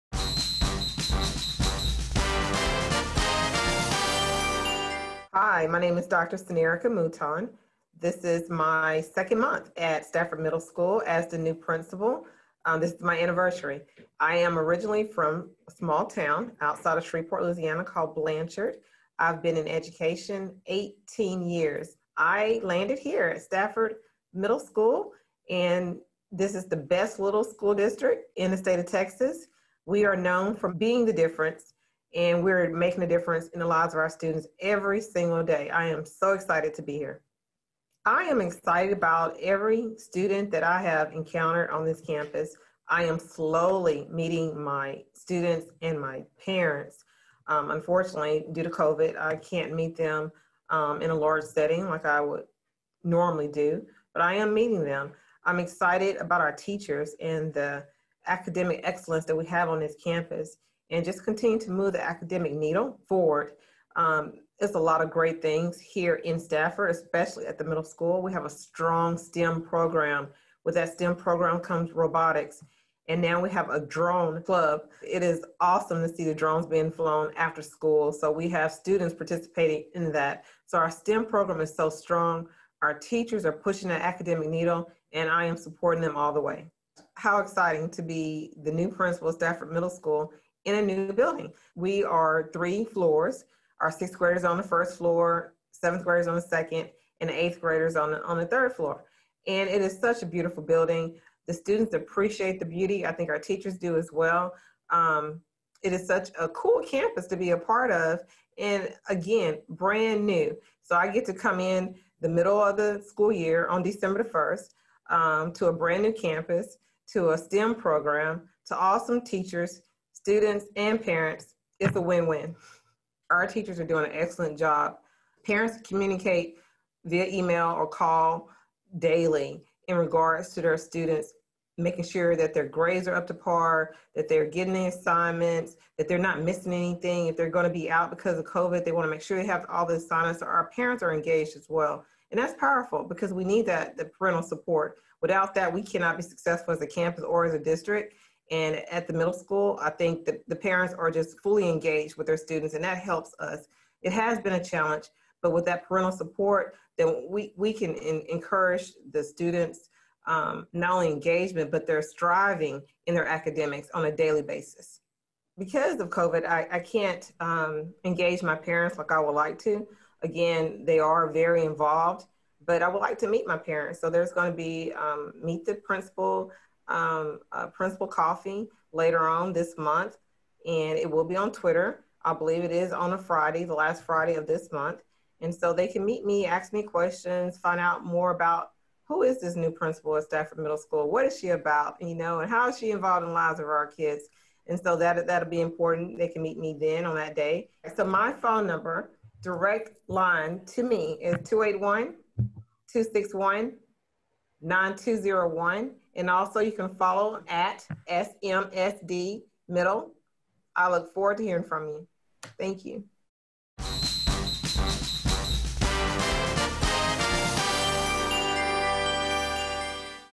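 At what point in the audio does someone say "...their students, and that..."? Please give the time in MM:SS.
02:32.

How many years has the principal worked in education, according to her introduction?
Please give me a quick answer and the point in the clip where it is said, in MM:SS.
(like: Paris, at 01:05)
18, at 00:20.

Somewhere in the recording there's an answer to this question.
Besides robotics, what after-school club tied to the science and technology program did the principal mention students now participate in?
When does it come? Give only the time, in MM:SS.
01:13.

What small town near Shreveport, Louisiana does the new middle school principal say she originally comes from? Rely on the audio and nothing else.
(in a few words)
Blanchard.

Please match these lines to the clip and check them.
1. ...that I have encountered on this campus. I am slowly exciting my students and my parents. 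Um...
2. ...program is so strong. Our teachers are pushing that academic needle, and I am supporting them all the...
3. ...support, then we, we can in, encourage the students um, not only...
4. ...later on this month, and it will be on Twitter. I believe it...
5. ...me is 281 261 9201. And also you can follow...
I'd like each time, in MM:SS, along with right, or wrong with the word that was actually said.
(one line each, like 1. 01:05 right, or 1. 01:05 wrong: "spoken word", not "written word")
1. 00:40 wrong: "meeting", not "exciting"
2. 01:21 right
3. 02:36 right
4. 02:58 right
5. 03:20 right.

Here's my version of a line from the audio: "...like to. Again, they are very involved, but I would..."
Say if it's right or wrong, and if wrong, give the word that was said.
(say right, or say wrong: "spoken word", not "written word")
right.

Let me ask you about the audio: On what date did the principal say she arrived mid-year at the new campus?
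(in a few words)
December 1.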